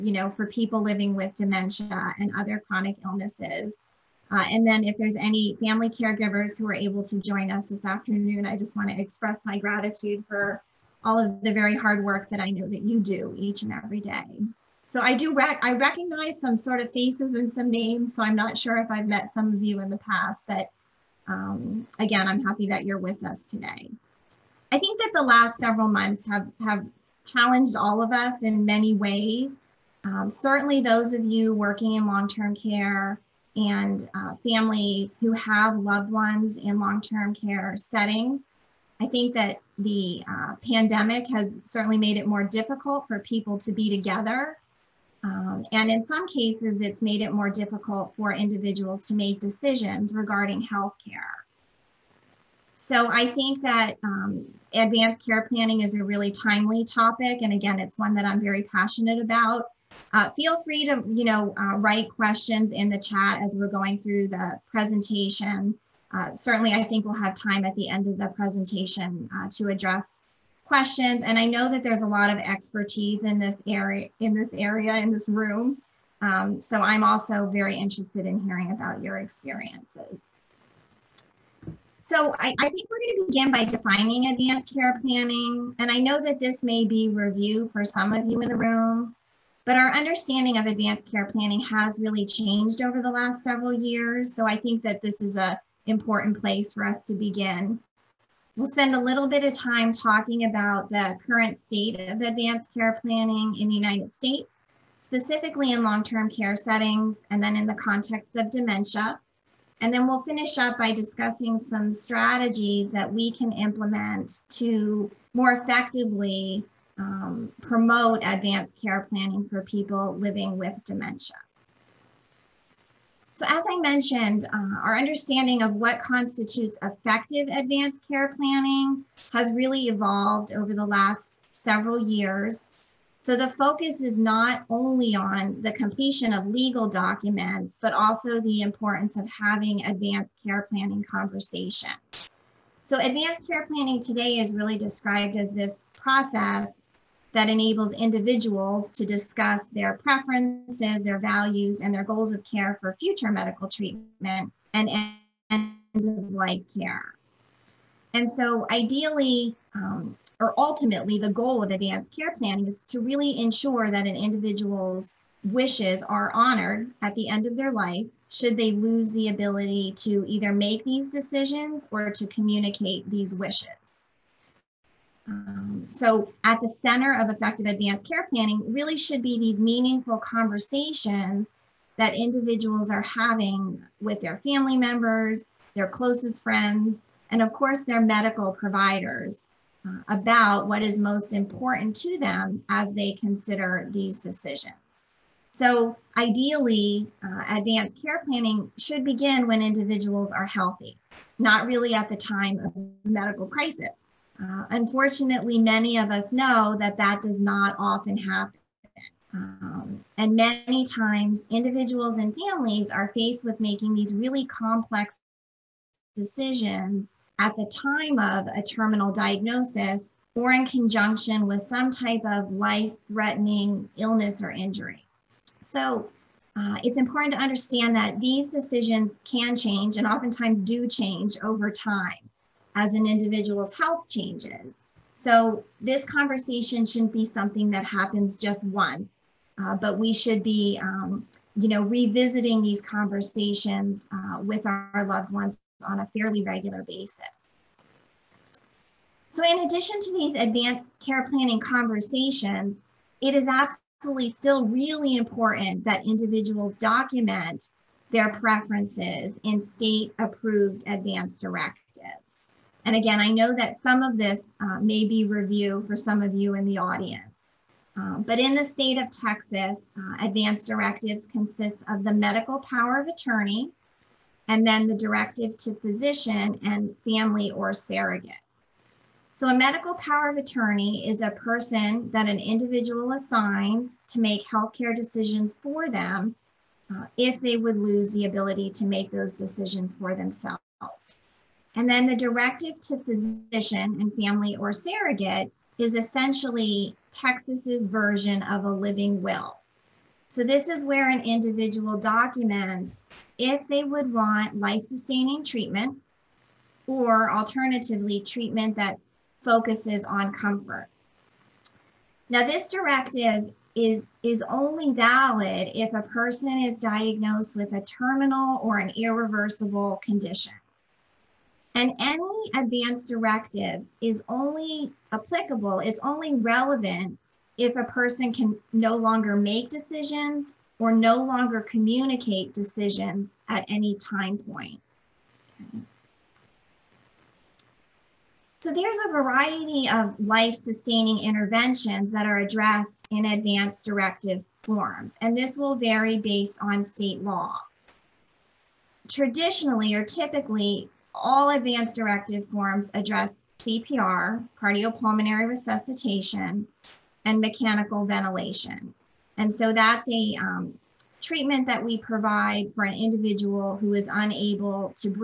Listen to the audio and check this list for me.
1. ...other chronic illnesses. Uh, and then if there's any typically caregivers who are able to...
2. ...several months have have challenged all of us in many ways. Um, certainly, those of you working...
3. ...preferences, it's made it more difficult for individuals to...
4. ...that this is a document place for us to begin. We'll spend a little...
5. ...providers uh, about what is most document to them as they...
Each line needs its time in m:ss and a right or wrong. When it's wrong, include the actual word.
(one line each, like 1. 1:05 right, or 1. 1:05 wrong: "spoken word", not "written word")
1. 0:02 wrong: "family", not "typically"
2. 0:25 right
3. 0:46 wrong: "cases", not "preferences"
4. 1:34 wrong: "important", not "document"
5. 3:08 wrong: "important", not "document".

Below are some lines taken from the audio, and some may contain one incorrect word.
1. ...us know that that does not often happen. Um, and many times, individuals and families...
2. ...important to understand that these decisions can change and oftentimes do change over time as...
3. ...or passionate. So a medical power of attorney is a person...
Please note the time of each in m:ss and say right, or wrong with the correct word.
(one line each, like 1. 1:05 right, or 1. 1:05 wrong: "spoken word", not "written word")
1. 3:26 right
2. 3:46 right
3. 4:37 wrong: "surrogate", not "passionate".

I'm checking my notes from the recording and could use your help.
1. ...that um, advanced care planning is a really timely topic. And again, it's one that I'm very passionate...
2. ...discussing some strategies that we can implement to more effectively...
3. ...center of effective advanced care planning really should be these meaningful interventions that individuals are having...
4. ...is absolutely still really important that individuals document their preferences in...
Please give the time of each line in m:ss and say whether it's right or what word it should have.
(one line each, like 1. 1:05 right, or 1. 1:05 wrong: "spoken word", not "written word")
1. 0:53 right
2. 1:50 right
3. 2:56 wrong: "conversations", not "interventions"
4. 4:13 right.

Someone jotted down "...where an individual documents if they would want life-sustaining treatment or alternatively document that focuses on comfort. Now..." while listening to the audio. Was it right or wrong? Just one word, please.
wrong.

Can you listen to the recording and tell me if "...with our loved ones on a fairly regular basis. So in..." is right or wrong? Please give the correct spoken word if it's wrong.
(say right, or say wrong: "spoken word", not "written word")
right.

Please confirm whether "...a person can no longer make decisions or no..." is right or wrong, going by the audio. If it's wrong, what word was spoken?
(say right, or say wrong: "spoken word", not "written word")
right.